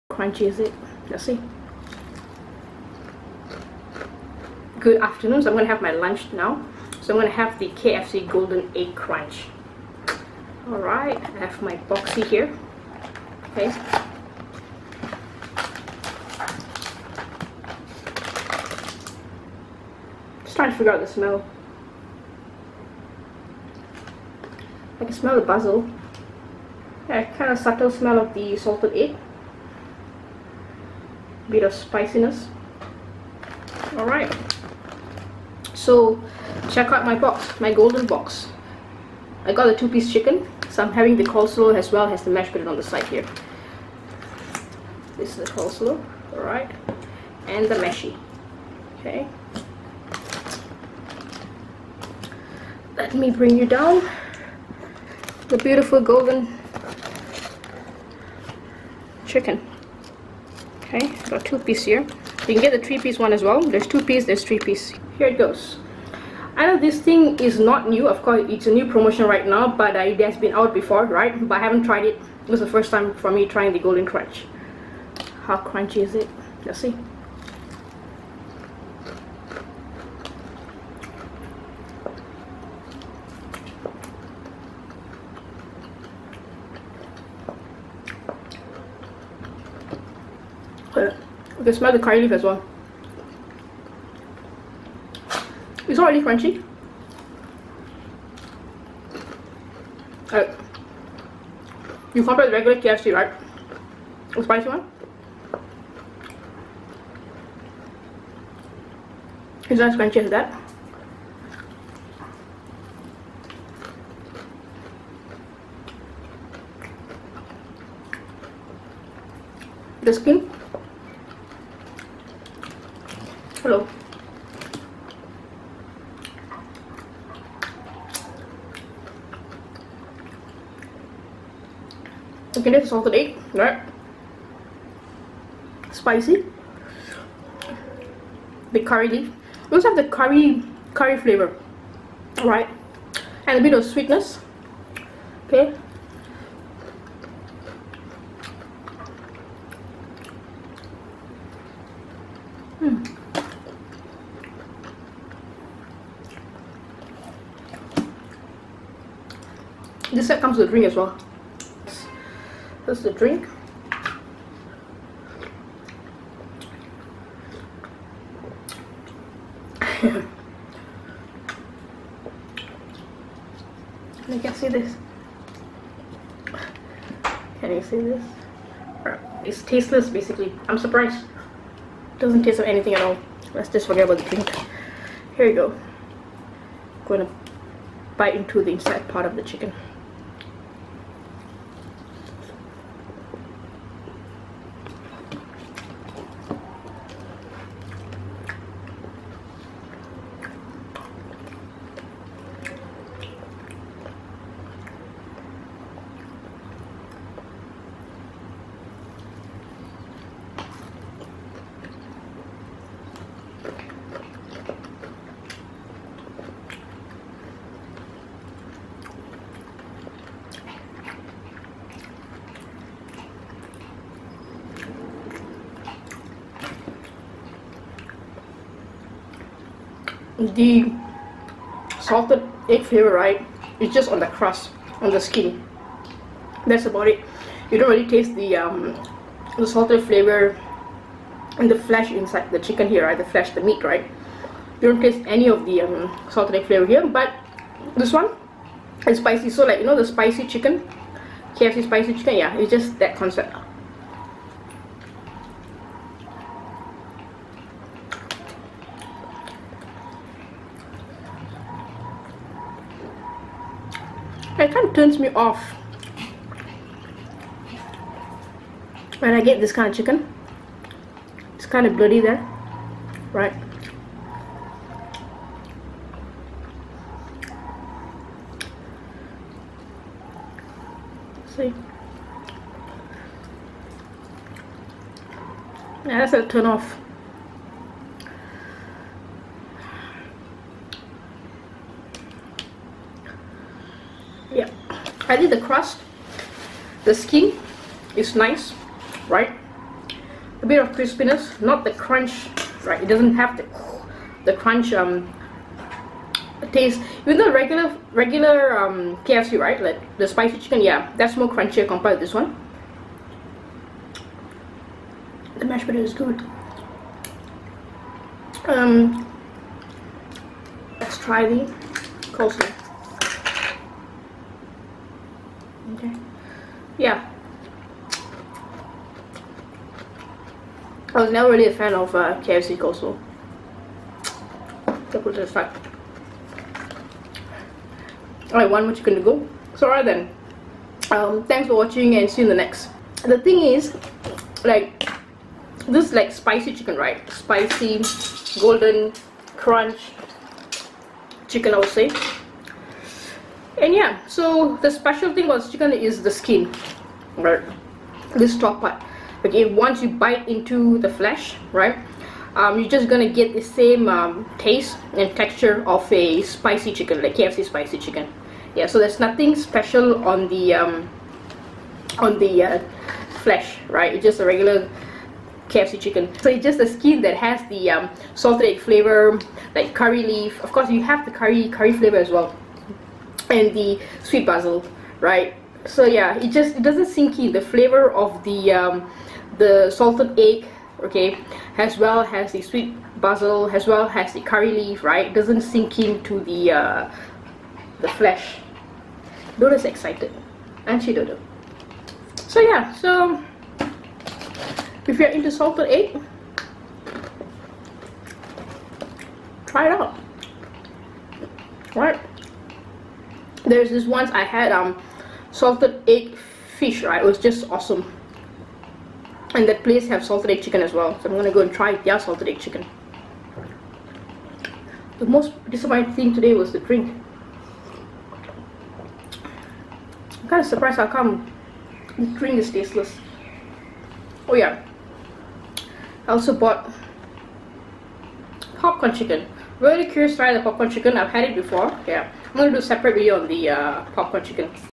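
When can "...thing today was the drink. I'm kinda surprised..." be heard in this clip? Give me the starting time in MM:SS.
07:06.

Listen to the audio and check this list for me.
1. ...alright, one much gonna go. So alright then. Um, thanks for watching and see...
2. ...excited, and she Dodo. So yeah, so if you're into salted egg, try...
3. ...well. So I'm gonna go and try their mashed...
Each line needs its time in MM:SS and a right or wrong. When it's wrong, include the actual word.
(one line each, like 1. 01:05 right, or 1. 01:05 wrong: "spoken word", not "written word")
1. 05:38 right
2. 06:39 right
3. 07:00 wrong: "salted", not "mashed".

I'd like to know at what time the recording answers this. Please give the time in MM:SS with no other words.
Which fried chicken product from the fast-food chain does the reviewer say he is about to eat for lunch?
00:07.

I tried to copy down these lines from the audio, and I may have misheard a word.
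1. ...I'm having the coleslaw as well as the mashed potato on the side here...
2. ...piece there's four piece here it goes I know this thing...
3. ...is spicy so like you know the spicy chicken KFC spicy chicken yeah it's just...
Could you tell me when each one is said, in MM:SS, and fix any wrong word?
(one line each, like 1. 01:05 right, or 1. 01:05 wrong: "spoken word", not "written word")
1. 00:40 right
2. 01:04 wrong: "three", not "four"
3. 04:09 right.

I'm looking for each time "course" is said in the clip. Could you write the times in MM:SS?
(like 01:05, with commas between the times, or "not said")
01:08, 06:20.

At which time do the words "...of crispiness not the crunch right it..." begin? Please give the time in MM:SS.
05:00.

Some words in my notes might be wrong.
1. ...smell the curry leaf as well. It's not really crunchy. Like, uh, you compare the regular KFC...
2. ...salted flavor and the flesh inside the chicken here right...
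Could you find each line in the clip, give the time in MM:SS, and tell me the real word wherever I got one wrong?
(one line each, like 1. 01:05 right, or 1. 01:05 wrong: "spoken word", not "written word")
1. 01:31 right
2. 03:59 right.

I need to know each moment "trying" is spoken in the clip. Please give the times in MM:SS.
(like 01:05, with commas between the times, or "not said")
00:20, 01:13.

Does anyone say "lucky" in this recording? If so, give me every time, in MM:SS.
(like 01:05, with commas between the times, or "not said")
not said.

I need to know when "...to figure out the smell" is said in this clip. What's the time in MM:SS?
00:20.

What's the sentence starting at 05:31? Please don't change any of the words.
I was never really a fan of uh, KFC coleslaw.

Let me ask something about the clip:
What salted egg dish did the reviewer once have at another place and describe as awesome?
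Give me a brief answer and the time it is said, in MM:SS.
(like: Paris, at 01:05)
salted egg fish, at 06:55.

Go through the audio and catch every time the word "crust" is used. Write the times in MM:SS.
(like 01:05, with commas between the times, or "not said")
03:54, 04:55.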